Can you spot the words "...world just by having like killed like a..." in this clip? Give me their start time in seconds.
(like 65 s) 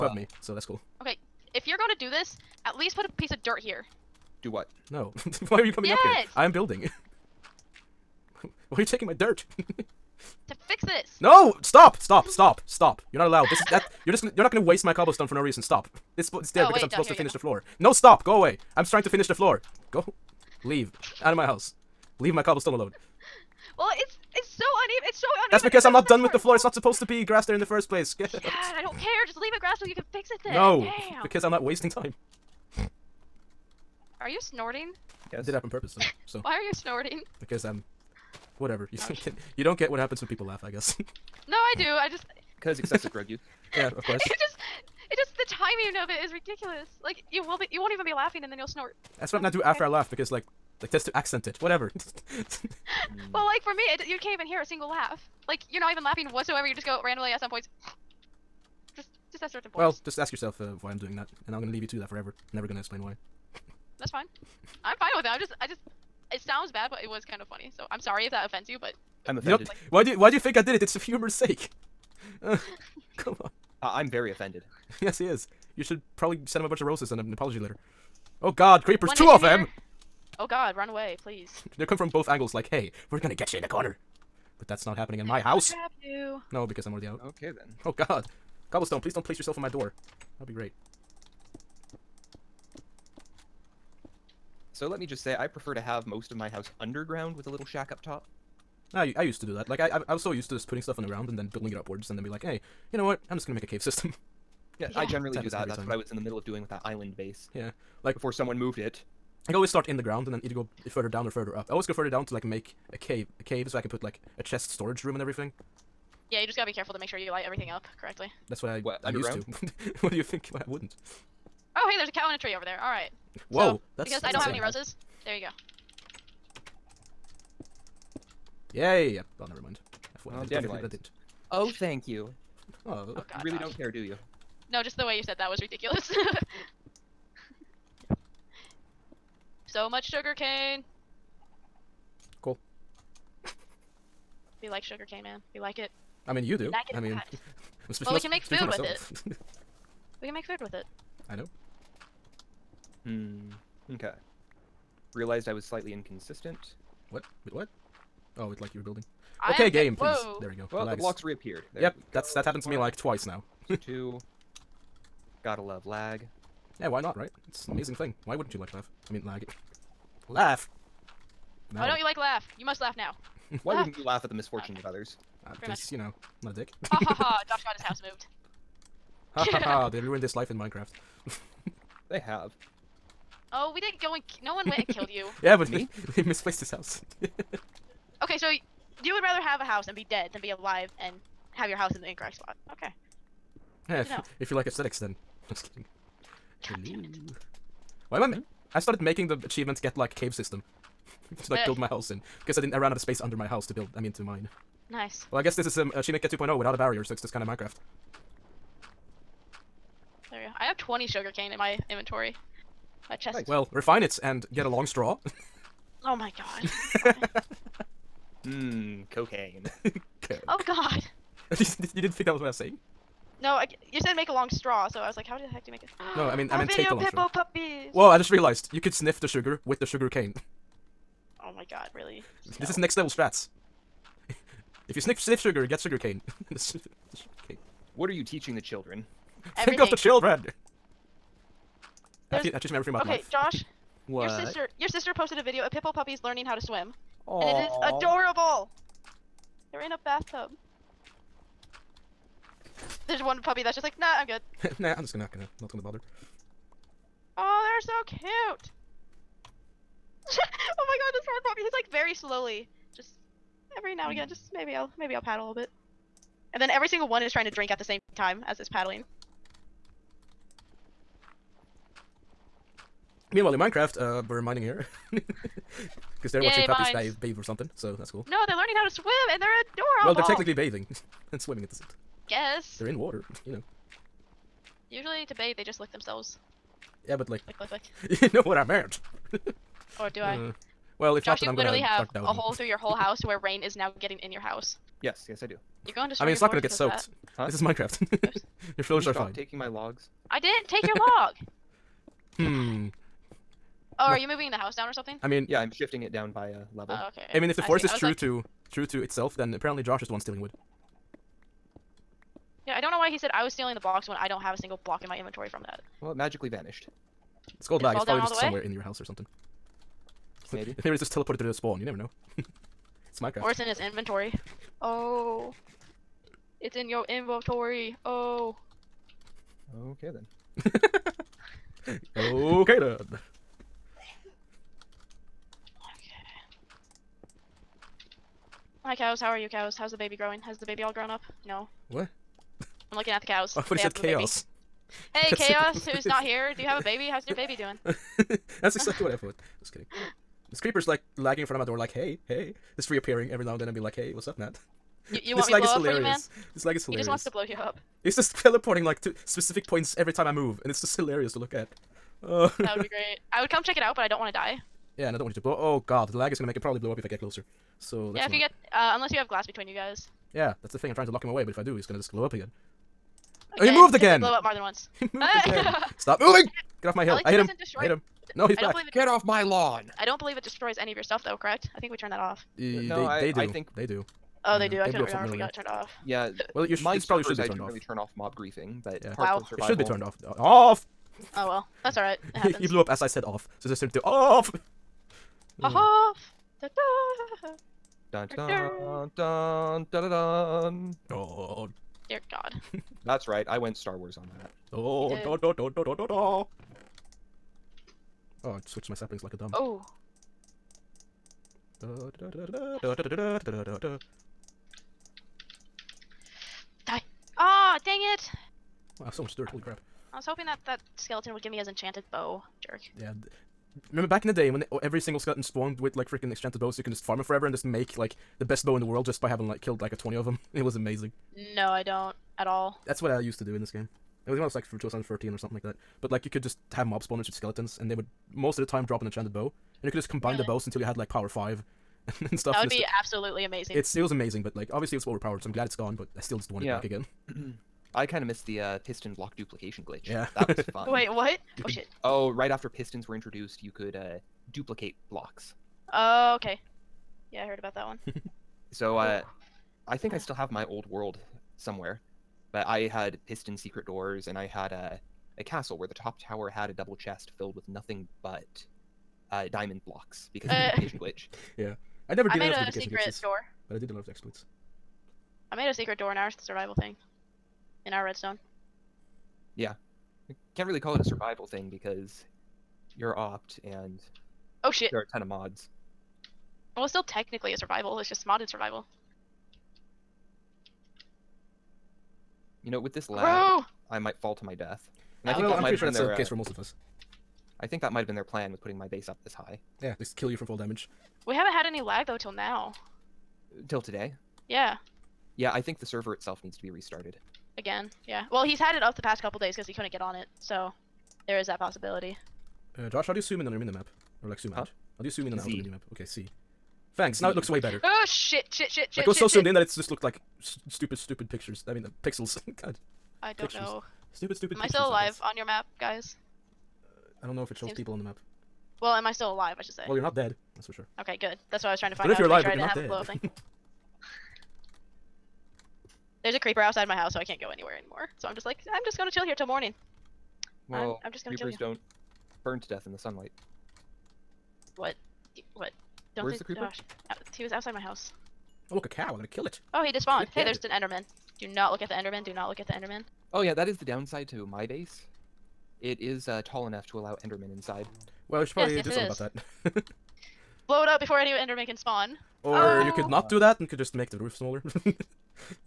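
428 s.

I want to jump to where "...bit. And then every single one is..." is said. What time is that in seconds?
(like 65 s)
265 s.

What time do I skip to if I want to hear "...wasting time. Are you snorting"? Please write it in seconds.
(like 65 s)
31 s.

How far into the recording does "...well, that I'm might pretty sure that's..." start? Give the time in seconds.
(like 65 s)
495 s.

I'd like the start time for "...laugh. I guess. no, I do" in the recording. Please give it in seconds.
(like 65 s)
40 s.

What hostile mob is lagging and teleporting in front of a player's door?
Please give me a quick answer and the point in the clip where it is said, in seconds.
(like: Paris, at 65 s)
A creeper, at 350 s.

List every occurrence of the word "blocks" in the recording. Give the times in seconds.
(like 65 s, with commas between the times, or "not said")
160 s, 314 s, 449 s, 455 s, 469 s.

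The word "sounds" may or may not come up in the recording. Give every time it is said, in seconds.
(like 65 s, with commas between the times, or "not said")
66 s.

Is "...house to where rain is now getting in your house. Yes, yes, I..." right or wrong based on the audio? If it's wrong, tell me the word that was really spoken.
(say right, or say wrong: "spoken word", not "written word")
right.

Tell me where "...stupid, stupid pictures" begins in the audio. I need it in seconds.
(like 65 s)
520 s.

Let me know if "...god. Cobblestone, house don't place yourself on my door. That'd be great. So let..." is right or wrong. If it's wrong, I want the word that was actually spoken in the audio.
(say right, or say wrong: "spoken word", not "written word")
wrong: "please", not "house".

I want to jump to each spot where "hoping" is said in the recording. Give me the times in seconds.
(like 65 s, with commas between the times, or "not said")
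420 s.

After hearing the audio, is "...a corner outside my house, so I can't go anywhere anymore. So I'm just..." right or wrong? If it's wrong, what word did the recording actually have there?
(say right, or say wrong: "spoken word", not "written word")
wrong: "creeper", not "corner".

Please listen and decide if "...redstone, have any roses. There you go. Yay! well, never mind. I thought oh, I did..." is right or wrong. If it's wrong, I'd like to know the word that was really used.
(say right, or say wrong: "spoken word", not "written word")
wrong: "insane", not "redstone".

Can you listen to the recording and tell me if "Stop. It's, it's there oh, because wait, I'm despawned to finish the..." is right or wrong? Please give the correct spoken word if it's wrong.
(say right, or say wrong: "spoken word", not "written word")
wrong: "supposed", not "despawned".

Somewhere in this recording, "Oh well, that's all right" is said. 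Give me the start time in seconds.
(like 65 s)
391 s.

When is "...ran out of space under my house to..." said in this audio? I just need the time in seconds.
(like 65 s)
202 s.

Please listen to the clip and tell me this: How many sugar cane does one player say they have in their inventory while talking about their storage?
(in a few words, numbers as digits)
20.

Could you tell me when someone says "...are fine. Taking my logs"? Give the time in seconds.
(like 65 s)
299 s.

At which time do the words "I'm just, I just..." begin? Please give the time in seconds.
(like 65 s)
65 s.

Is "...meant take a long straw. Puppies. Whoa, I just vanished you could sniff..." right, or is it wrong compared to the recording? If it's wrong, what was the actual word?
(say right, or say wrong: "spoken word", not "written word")
wrong: "realized", not "vanished".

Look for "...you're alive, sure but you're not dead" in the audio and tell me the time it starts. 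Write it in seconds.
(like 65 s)
532 s.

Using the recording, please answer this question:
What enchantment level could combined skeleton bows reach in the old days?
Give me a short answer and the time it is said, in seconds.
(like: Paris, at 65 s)
Power 5, at 441 s.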